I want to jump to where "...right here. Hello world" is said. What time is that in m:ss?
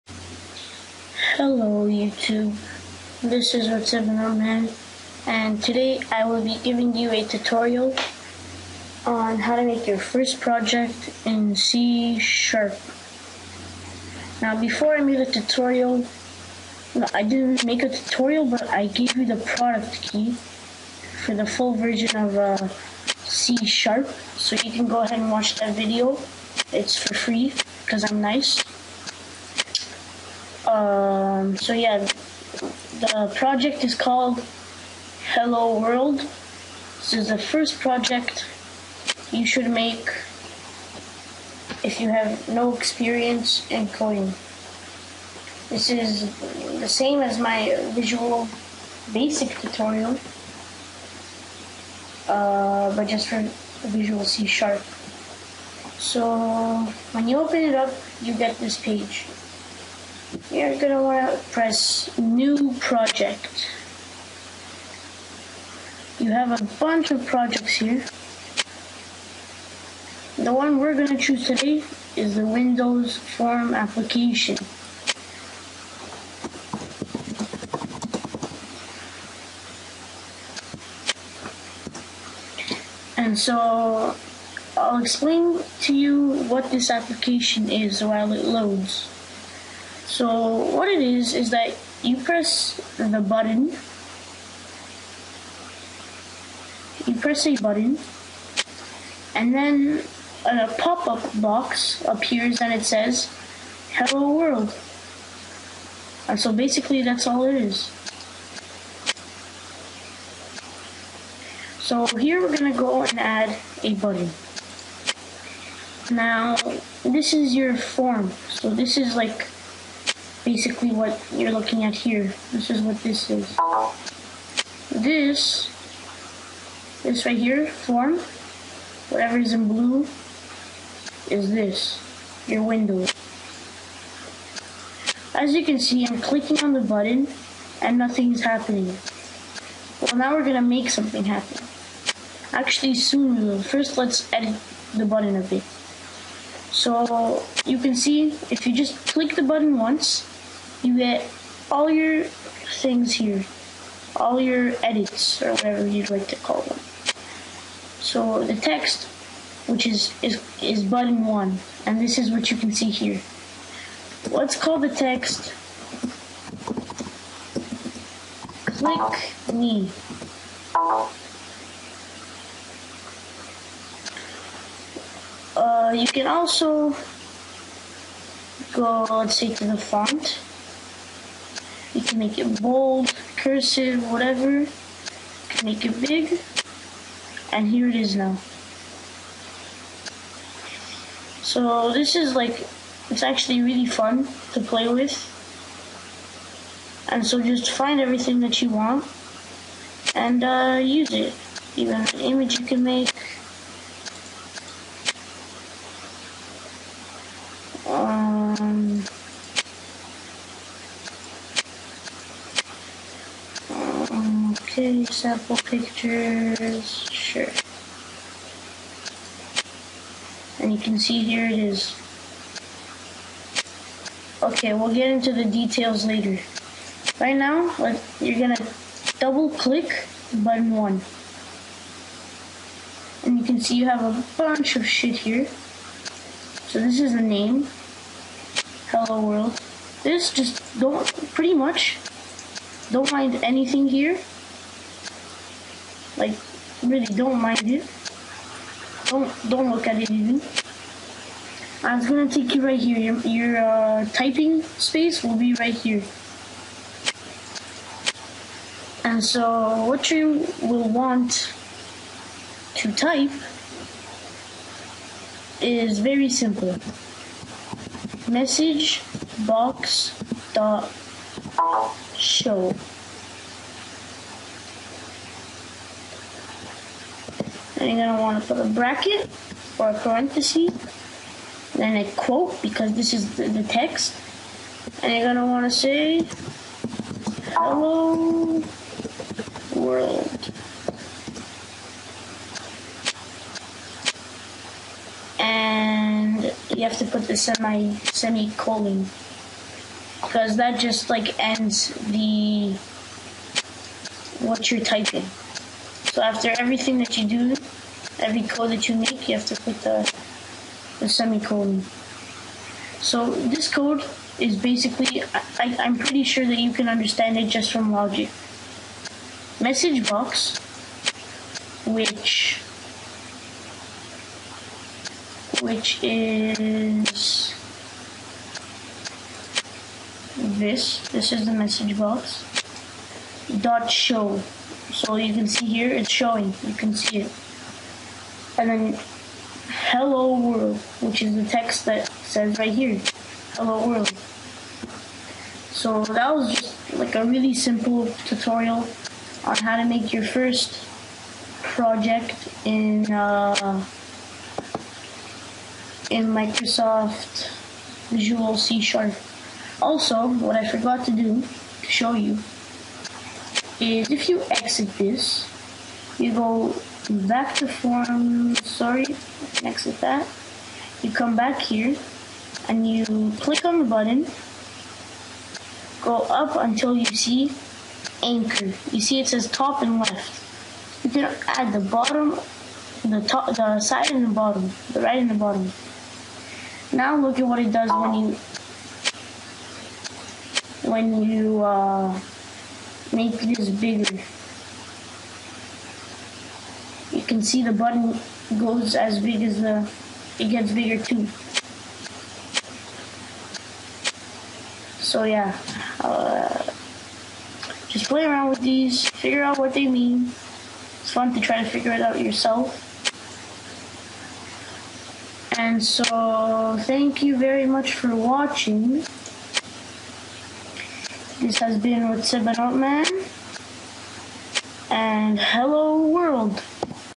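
5:42.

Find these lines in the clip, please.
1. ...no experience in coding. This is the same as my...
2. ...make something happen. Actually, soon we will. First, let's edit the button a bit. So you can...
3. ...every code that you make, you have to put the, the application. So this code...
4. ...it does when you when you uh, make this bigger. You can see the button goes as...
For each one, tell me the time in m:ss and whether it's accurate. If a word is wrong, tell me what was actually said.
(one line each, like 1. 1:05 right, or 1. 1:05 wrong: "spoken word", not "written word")
1. 0:42 right
2. 2:20 right
3. 5:08 wrong: "semicolon", not "application"
4. 6:27 right.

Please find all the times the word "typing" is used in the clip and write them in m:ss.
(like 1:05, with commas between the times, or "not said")
4:14, 5:04.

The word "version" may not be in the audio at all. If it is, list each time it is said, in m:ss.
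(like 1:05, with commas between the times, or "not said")
0:21.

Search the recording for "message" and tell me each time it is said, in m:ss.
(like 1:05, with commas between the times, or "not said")
4:28, 5:19, 5:31.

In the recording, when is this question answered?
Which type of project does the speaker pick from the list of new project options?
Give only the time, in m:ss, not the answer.
1:12.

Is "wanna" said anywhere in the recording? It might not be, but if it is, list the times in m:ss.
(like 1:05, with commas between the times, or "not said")
1:01.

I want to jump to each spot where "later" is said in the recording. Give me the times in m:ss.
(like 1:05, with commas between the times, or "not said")
3:46.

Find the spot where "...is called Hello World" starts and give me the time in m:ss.
0:33.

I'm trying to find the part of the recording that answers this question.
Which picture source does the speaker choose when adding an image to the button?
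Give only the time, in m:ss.
3:35.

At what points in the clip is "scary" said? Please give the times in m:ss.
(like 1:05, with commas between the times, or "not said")
not said.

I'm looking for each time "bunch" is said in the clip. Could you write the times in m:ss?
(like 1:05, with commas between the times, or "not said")
1:06, 3:54.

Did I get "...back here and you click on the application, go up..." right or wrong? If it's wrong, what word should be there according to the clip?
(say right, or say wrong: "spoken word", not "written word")
wrong: "button", not "application".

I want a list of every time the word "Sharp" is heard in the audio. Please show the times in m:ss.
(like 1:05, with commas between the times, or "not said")
0:12, 0:23, 0:54, 5:58.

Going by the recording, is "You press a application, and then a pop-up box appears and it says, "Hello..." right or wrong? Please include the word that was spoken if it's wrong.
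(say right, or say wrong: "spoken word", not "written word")
wrong: "button", not "application".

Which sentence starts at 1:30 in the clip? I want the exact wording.
So what it is is that you press the button.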